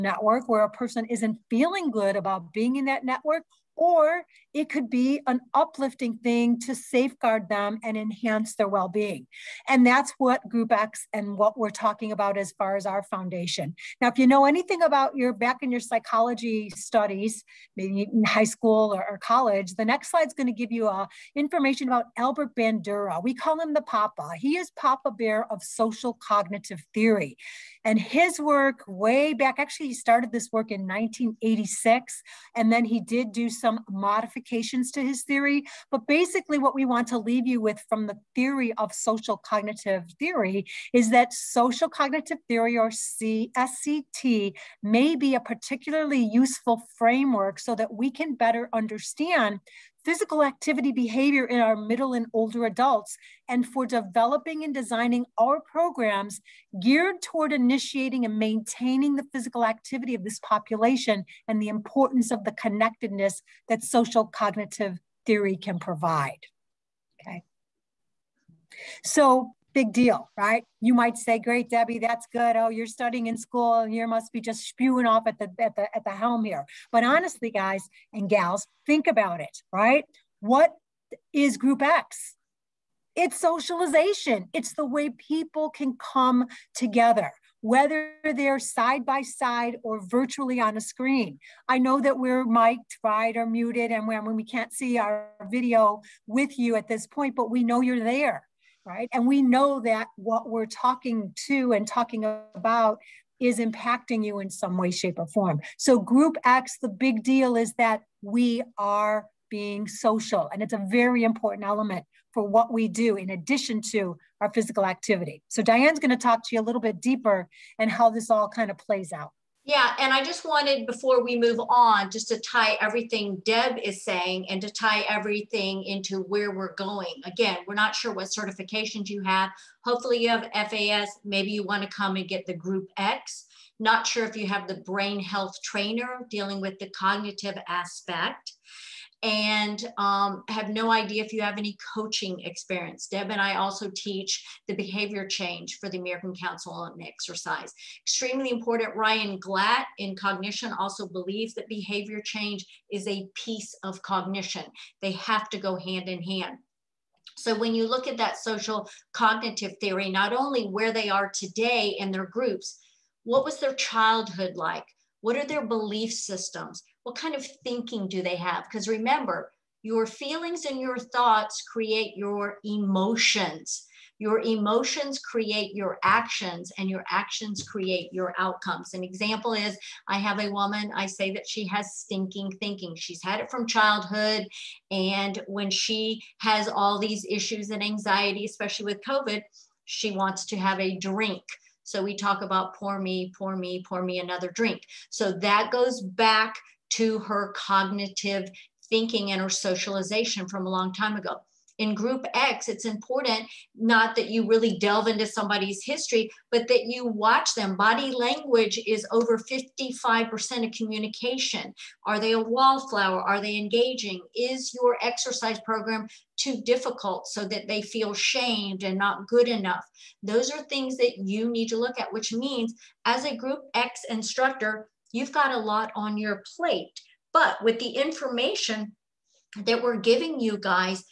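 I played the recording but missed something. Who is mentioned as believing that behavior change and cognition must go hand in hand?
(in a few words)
Ryan Glatt.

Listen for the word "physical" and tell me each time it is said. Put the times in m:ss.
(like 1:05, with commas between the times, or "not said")
0:50, 0:59, 1:54.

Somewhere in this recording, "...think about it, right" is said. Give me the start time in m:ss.
1:18.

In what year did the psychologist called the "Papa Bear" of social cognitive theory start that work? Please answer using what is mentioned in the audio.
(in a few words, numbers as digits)
1986.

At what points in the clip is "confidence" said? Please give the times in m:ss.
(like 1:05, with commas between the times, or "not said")
not said.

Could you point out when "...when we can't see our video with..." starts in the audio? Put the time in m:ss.
1:34.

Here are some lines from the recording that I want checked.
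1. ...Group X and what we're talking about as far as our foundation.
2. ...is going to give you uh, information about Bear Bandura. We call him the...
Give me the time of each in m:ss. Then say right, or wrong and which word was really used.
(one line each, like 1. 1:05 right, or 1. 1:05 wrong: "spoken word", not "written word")
1. 0:10 right
2. 0:20 wrong: "Albert", not "Bear".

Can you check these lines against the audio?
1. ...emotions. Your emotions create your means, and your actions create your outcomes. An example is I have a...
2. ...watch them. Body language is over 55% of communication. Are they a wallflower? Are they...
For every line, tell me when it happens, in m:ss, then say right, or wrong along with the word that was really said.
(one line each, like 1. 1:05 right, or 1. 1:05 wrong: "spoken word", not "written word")
1. 2:52 wrong: "actions", not "means"
2. 3:27 right.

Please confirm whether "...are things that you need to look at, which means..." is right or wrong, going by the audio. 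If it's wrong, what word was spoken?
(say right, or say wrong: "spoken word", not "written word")
right.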